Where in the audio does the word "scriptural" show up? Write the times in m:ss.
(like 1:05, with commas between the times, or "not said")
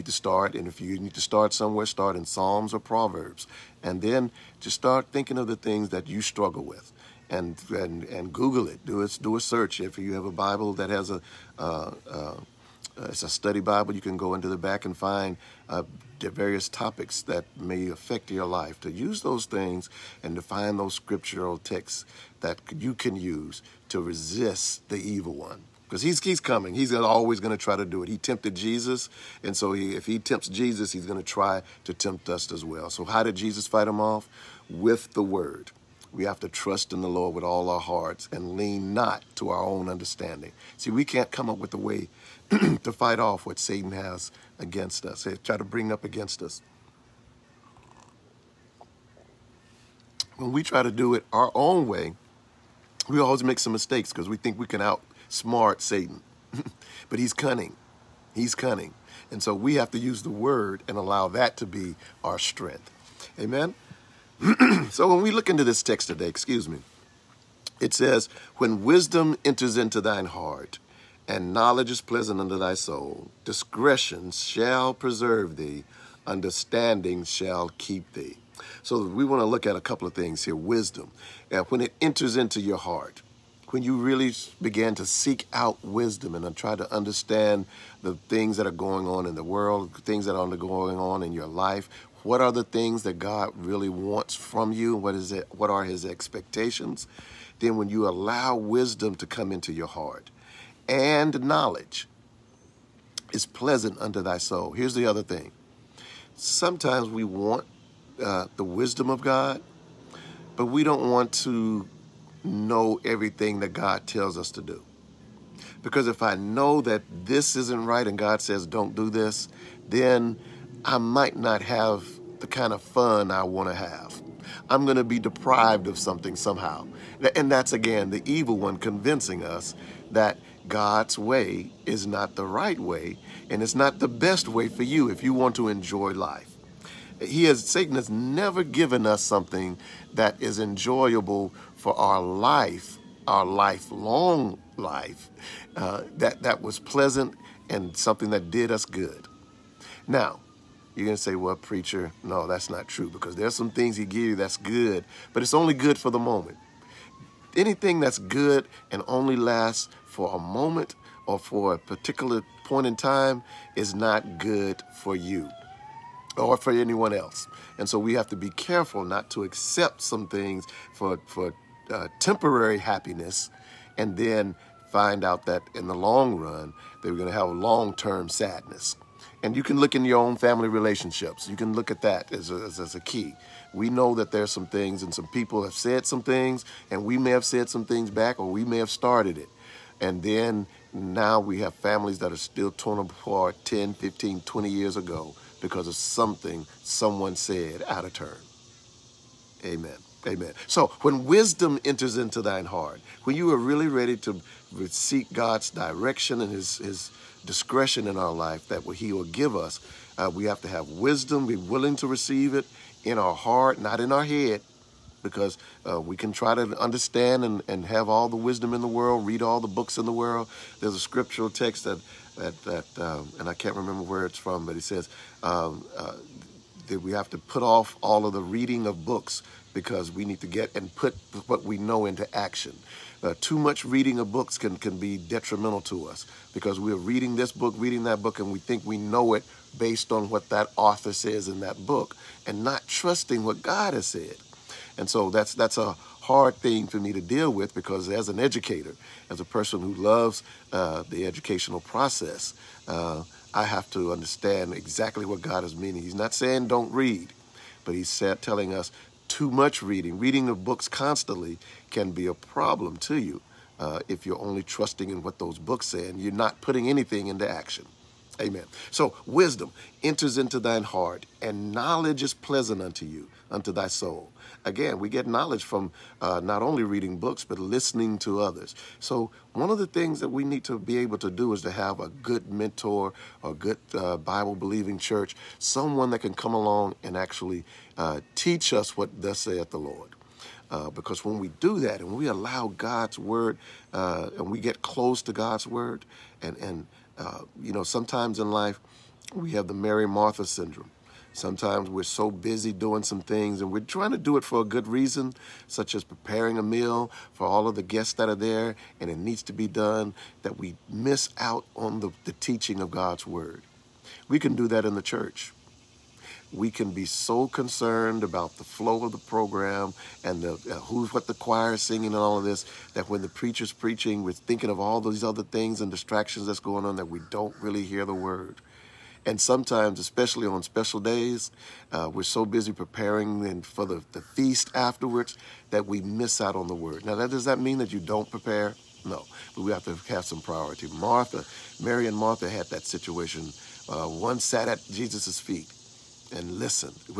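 0:20, 3:40.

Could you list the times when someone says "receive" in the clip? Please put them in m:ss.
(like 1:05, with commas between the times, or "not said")
3:32.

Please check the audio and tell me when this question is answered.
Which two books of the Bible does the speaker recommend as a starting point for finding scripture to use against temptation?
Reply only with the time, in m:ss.
0:02.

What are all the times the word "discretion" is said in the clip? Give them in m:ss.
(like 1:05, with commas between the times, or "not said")
1:13, 3:27.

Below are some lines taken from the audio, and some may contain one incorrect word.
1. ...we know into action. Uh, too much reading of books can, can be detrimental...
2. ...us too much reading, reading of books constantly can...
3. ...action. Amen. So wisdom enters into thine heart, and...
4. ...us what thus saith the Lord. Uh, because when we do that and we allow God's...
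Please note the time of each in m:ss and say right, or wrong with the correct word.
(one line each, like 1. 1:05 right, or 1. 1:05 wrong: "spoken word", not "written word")
1. 3:51 right
2. 4:18 right
3. 4:27 right
4. 4:48 right.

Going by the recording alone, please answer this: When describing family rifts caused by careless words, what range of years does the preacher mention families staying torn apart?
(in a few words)
10, 15, 20 years.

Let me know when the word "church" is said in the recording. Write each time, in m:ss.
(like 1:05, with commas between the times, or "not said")
4:44, 5:15.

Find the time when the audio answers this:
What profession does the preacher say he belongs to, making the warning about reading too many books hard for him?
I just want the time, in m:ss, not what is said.
4:08.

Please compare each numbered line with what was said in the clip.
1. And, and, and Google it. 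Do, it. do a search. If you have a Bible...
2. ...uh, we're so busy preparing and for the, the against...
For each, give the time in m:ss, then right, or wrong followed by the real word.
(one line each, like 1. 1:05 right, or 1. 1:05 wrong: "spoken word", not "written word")
1. 0:07 right
2. 5:31 wrong: "feast", not "against".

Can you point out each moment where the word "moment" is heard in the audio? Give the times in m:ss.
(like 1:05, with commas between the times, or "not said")
2:36, 2:40.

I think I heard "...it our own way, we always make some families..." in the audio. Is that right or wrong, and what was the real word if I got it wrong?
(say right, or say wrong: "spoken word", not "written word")
wrong: "mistakes", not "families".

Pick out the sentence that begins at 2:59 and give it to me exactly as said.
And you can look in your own family relationships.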